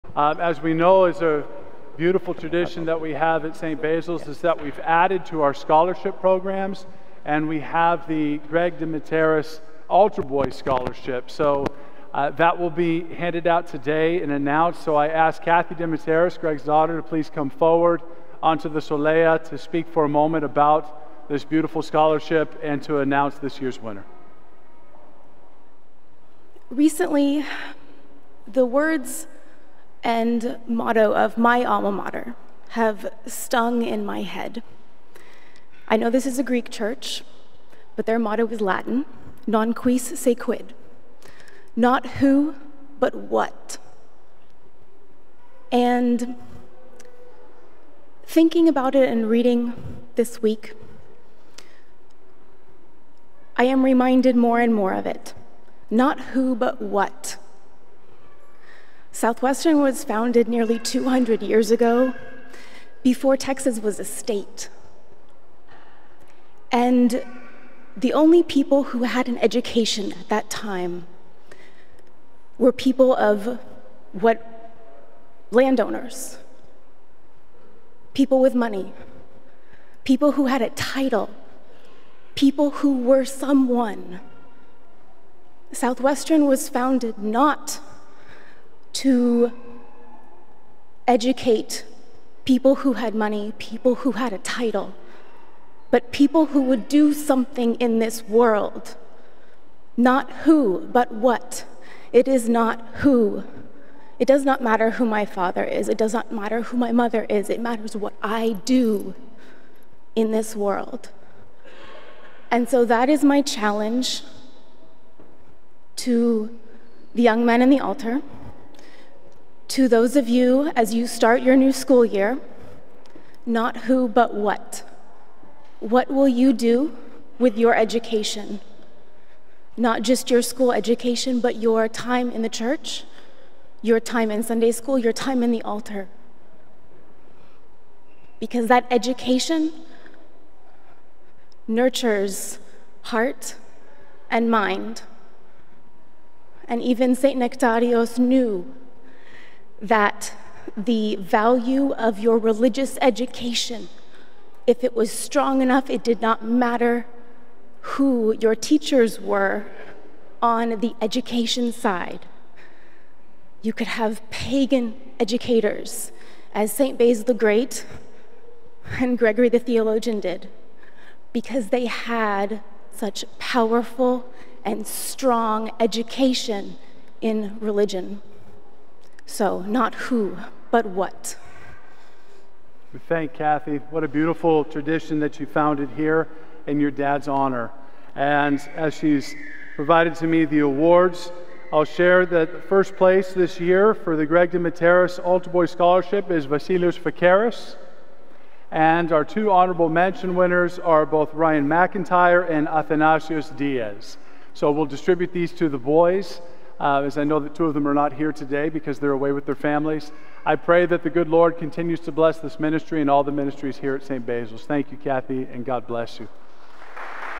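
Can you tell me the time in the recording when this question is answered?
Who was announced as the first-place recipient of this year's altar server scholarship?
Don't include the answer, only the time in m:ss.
3:16.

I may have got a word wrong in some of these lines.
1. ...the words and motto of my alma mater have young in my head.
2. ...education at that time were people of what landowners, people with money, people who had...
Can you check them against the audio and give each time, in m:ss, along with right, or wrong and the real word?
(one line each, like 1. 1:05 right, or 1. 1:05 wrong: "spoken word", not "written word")
1. 0:28 wrong: "stung", not "young"
2. 1:09 right.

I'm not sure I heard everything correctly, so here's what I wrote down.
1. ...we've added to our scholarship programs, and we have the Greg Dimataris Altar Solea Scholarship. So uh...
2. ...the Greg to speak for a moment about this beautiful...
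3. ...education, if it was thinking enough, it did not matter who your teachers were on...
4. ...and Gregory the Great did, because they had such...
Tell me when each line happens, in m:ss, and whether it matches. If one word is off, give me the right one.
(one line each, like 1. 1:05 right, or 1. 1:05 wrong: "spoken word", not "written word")
1. 0:04 wrong: "Boy", not "Solea"
2. 0:18 wrong: "Solea", not "Greg"
3. 2:33 wrong: "strong", not "thinking"
4. 2:48 wrong: "Theologian", not "Great".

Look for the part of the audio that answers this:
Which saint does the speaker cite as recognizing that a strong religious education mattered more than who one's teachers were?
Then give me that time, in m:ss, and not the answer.
2:27.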